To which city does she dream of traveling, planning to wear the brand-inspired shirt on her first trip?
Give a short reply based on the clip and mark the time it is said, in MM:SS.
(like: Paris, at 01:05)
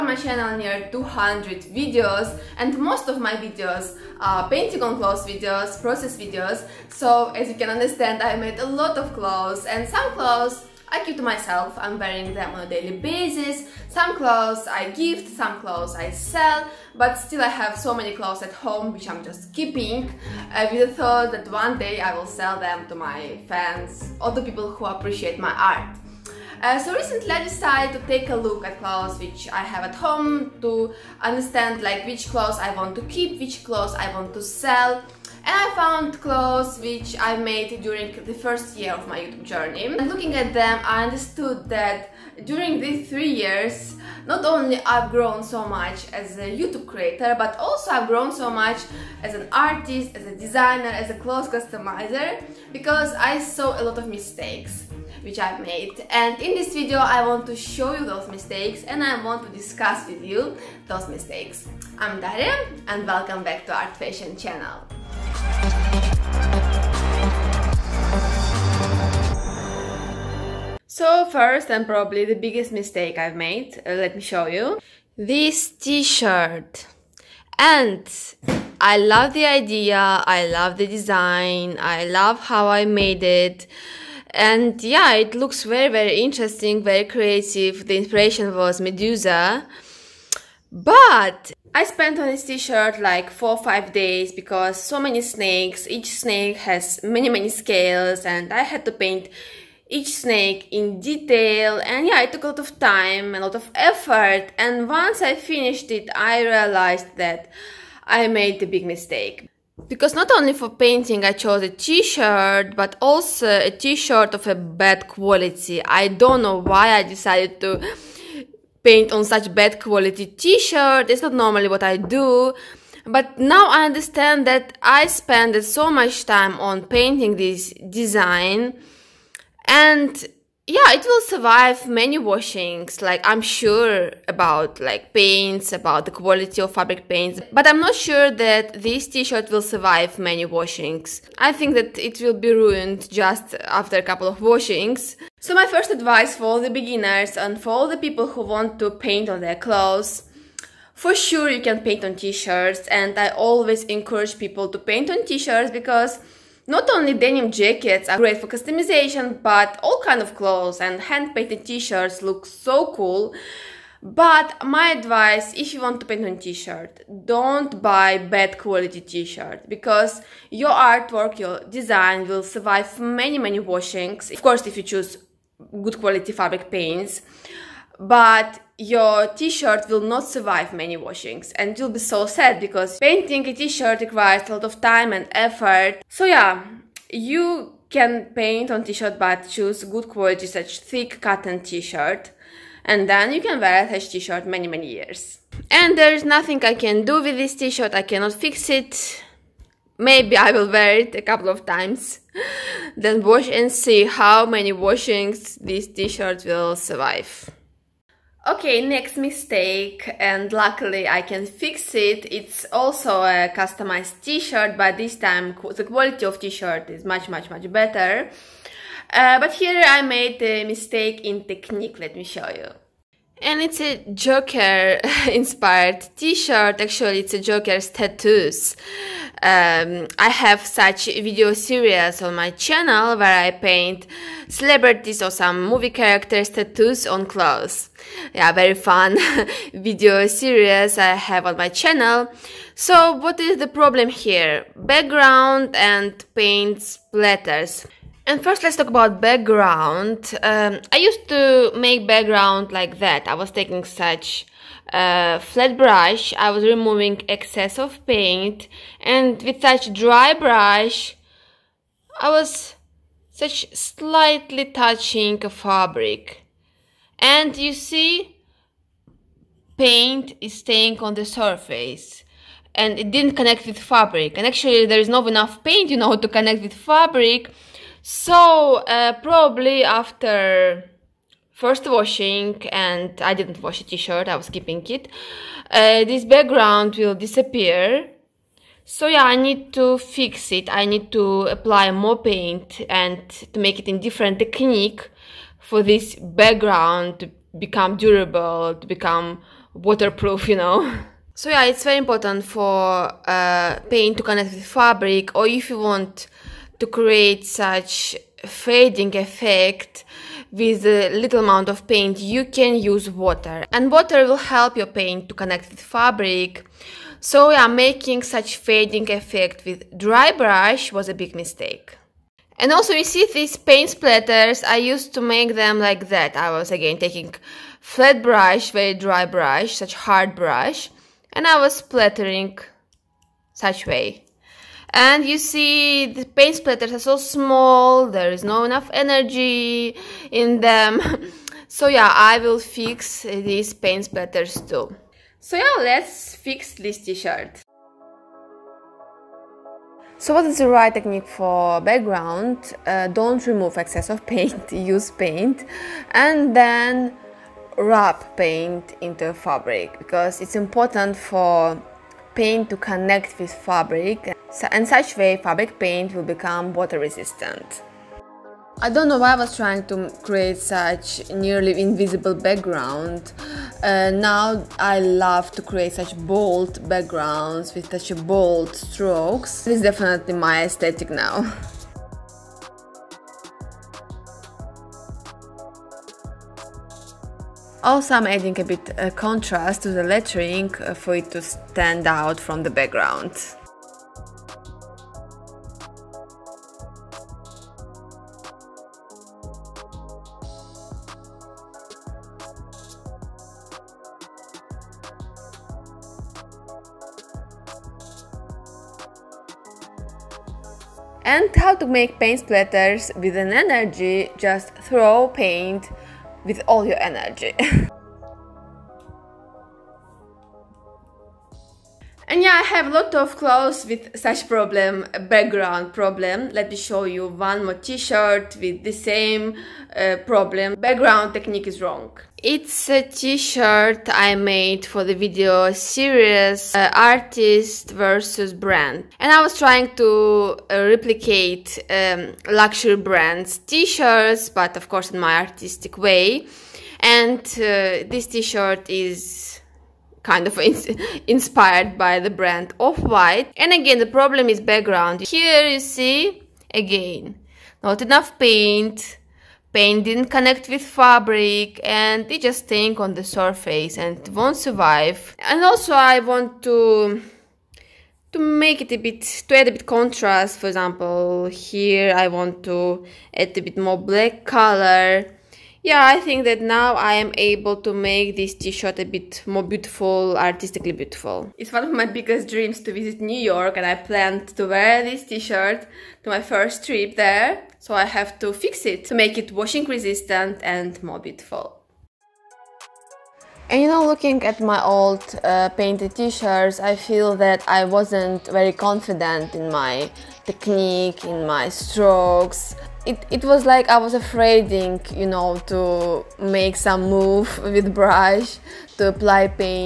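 New York, at 08:03.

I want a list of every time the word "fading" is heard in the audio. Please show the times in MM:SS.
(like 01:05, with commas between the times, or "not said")
05:08, 05:18.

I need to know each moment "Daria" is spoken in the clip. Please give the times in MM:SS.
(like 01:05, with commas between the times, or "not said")
01:02.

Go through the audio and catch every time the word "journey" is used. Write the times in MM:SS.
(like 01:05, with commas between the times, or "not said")
00:39.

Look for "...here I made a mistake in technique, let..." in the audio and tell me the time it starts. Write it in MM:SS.
03:39.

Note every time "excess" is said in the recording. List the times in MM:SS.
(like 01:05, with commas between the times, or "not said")
04:17, 05:53.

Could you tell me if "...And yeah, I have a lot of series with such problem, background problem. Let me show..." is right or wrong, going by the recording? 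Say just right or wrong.
wrong.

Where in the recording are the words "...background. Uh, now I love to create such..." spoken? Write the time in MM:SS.
06:12.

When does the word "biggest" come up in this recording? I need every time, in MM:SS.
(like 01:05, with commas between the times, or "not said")
01:12, 08:02.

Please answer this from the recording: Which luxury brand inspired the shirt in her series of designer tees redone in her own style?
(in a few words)
Off-White.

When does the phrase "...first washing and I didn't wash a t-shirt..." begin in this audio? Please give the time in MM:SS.
04:41.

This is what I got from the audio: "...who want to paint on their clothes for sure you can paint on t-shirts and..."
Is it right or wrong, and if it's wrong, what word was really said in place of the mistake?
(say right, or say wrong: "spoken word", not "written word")
right.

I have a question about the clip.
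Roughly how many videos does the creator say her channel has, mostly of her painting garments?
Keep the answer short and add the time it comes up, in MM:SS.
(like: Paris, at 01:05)
200, at 00:00.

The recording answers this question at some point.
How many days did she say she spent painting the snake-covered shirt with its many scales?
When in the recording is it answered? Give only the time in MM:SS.
01:33.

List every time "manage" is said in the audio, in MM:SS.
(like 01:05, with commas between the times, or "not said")
not said.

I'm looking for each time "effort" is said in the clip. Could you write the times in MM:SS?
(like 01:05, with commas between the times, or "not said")
01:43, 03:05.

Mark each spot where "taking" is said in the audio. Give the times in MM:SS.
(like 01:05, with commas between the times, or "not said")
04:13, 05:26.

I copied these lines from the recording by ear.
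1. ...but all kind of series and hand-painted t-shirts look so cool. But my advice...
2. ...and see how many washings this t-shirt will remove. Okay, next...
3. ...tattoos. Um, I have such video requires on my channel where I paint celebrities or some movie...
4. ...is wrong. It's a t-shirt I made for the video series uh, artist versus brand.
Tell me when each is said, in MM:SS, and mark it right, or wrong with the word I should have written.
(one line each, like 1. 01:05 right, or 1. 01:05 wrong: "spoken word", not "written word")
1. 02:39 wrong: "clothes", not "series"
2. 03:23 wrong: "survive", not "remove"
3. 03:47 wrong: "series", not "requires"
4. 07:11 right.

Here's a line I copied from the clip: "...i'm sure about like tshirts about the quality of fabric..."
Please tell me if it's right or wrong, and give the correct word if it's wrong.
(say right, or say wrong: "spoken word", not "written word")
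wrong: "paints", not "tshirts".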